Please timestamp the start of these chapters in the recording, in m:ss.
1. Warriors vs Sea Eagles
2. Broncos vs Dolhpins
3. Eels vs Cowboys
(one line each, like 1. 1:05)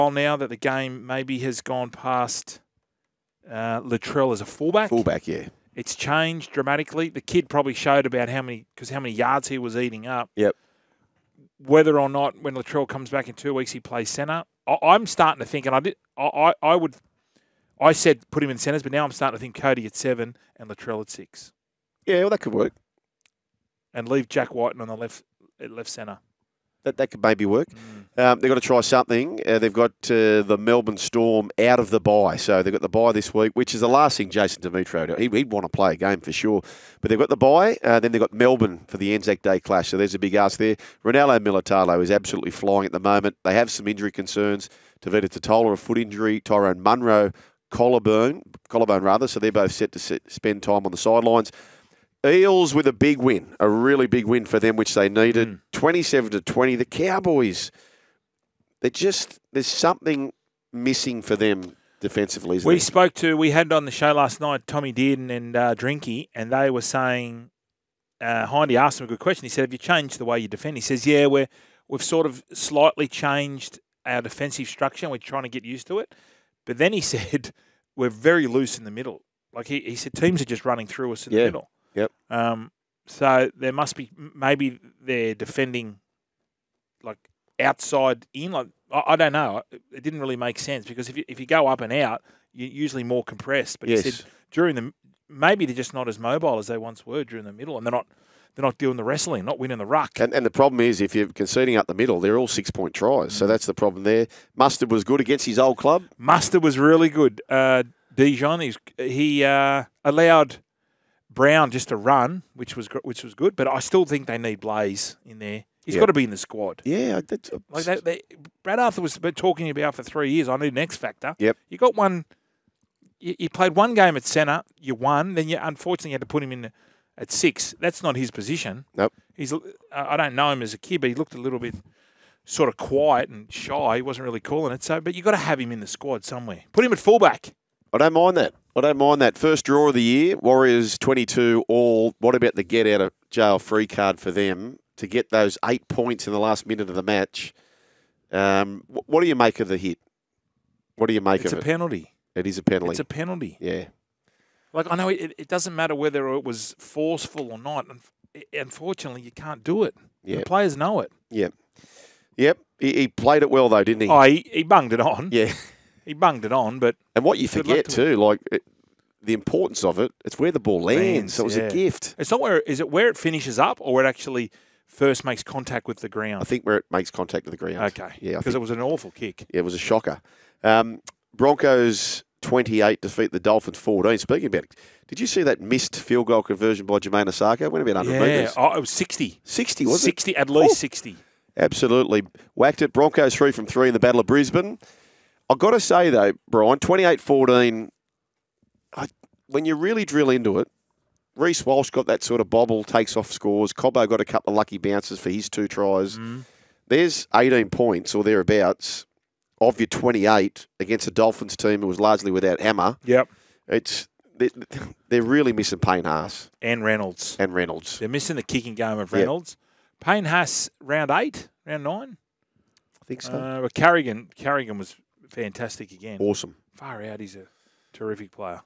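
1. 2:25
2. 3:00
3. 1:00.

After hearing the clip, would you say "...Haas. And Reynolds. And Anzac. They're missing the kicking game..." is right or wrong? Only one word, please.
wrong.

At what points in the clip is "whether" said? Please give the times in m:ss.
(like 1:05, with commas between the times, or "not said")
0:11, 2:35.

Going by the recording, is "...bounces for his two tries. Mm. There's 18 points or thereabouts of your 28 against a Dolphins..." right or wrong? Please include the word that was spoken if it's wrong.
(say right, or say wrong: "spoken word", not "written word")
right.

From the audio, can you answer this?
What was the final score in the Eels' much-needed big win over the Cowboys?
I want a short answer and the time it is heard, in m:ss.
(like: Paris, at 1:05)
27-20, at 0:55.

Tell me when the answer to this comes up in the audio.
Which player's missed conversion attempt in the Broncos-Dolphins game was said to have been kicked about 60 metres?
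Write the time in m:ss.
3:06.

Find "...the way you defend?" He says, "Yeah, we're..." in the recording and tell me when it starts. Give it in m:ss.
1:10.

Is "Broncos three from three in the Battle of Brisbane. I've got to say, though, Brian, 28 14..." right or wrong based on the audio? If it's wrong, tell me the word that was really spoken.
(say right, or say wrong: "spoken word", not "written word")
right.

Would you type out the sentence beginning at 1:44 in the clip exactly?
Mustard was good against his old club.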